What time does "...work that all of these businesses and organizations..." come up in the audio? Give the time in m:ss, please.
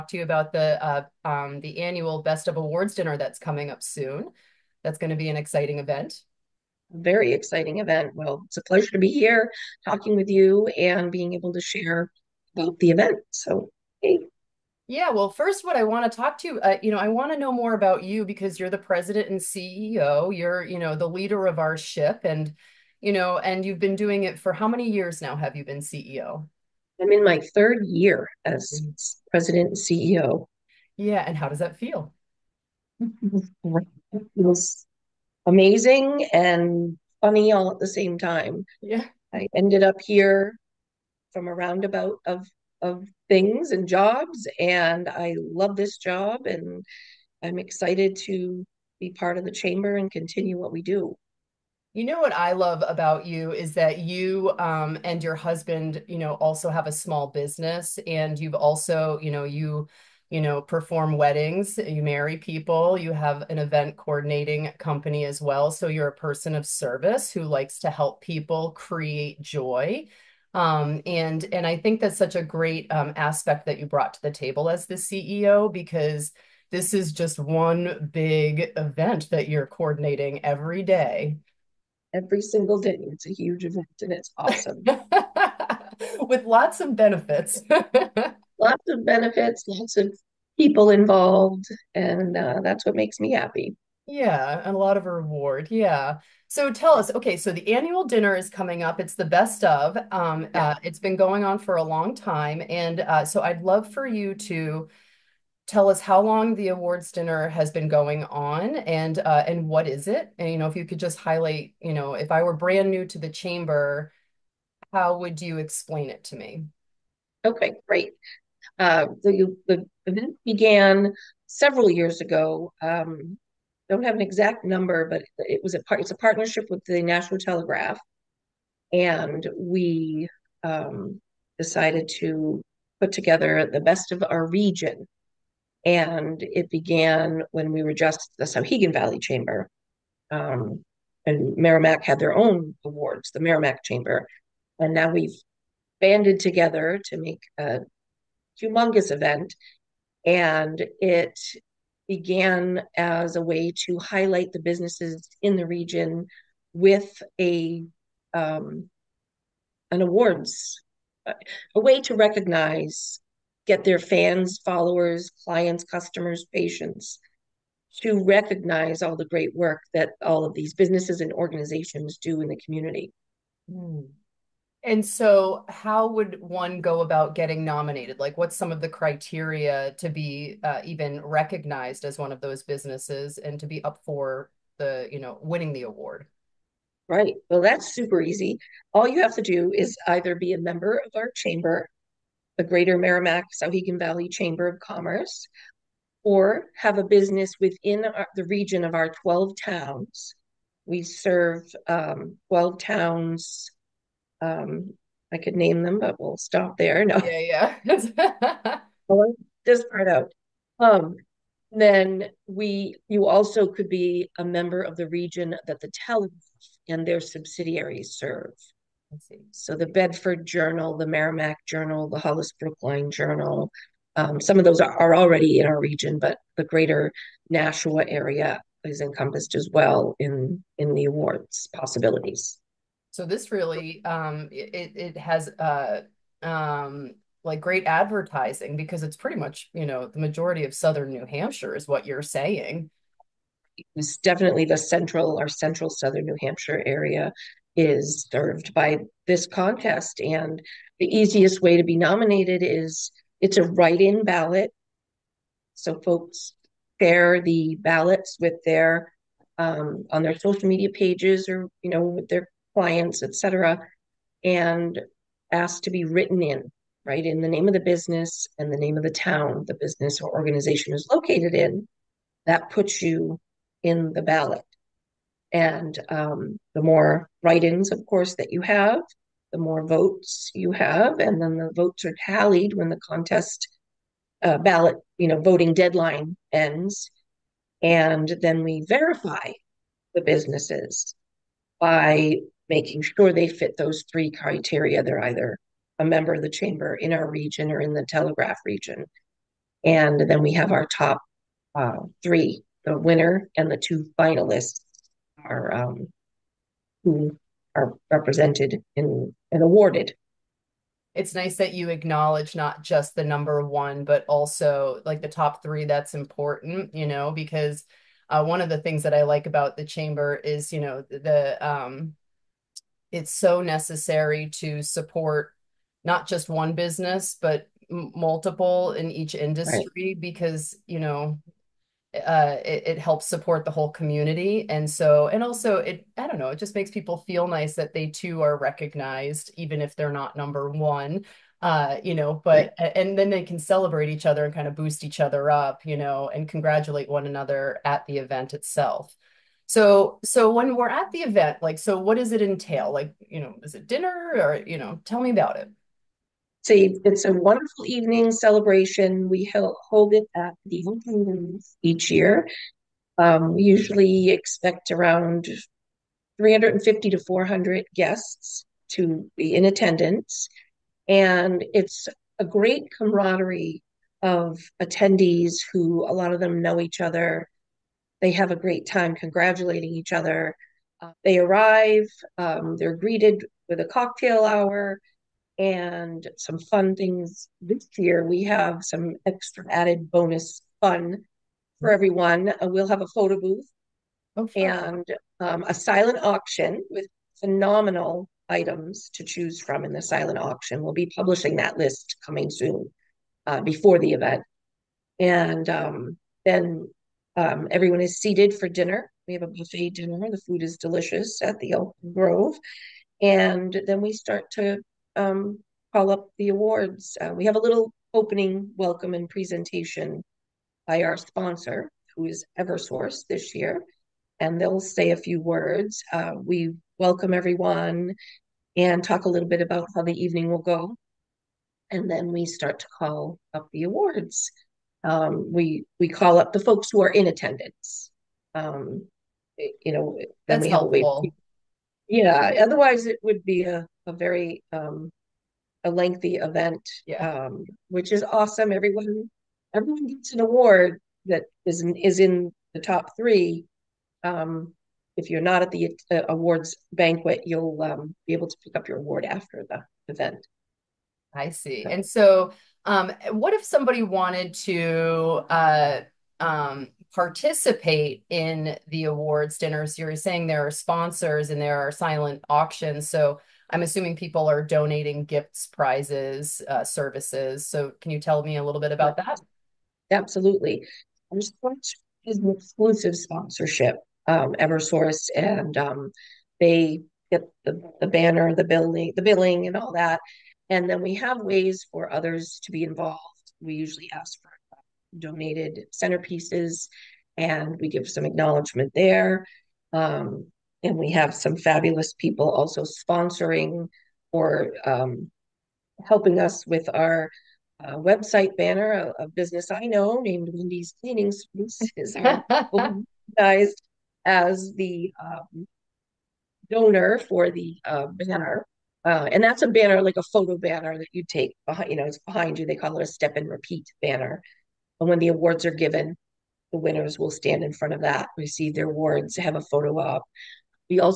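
2:49.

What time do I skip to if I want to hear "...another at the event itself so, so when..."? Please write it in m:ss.
5:47.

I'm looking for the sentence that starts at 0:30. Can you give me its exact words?
Yeah, and how does that feel?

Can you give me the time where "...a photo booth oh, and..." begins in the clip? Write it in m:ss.
6:33.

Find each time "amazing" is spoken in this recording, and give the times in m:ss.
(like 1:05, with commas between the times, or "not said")
0:35.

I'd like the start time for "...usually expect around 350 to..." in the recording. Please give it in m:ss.
6:03.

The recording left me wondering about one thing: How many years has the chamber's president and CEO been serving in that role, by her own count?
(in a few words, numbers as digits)
3.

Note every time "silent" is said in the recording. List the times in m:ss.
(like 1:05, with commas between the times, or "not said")
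6:35, 6:39, 7:51.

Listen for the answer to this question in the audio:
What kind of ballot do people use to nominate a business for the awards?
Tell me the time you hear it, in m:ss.
4:13.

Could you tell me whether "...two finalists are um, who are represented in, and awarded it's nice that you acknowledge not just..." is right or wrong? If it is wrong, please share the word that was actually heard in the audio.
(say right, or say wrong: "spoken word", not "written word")
right.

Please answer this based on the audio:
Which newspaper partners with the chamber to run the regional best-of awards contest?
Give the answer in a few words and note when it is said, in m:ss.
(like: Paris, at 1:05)
Nashua Telegraph, at 2:07.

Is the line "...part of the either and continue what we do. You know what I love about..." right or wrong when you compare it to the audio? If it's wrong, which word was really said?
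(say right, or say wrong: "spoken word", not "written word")
wrong: "chamber", not "either".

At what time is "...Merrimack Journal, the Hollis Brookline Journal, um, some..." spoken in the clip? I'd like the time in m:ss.
3:41.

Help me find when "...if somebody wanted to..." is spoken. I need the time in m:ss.
7:43.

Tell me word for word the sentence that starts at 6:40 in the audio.
We'll be publishing that list coming soon uh, before the event.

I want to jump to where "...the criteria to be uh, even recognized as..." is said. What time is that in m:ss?
2:58.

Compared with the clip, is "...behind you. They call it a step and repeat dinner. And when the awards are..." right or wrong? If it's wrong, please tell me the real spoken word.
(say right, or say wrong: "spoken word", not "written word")
wrong: "banner", not "dinner".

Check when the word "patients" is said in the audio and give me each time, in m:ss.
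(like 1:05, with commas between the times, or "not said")
2:46.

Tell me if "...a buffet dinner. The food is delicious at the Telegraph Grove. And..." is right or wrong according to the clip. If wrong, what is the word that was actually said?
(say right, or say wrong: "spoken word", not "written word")
wrong: "Elk", not "Telegraph".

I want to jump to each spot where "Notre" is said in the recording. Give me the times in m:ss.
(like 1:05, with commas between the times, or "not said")
not said.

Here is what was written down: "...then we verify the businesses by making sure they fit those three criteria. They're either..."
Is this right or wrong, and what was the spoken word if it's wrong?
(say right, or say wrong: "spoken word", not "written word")
right.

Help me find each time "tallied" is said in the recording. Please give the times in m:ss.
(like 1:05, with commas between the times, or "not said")
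4:42.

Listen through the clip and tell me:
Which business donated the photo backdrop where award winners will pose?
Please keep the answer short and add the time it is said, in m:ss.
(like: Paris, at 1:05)
Wendy's Cleaning Services, at 8:30.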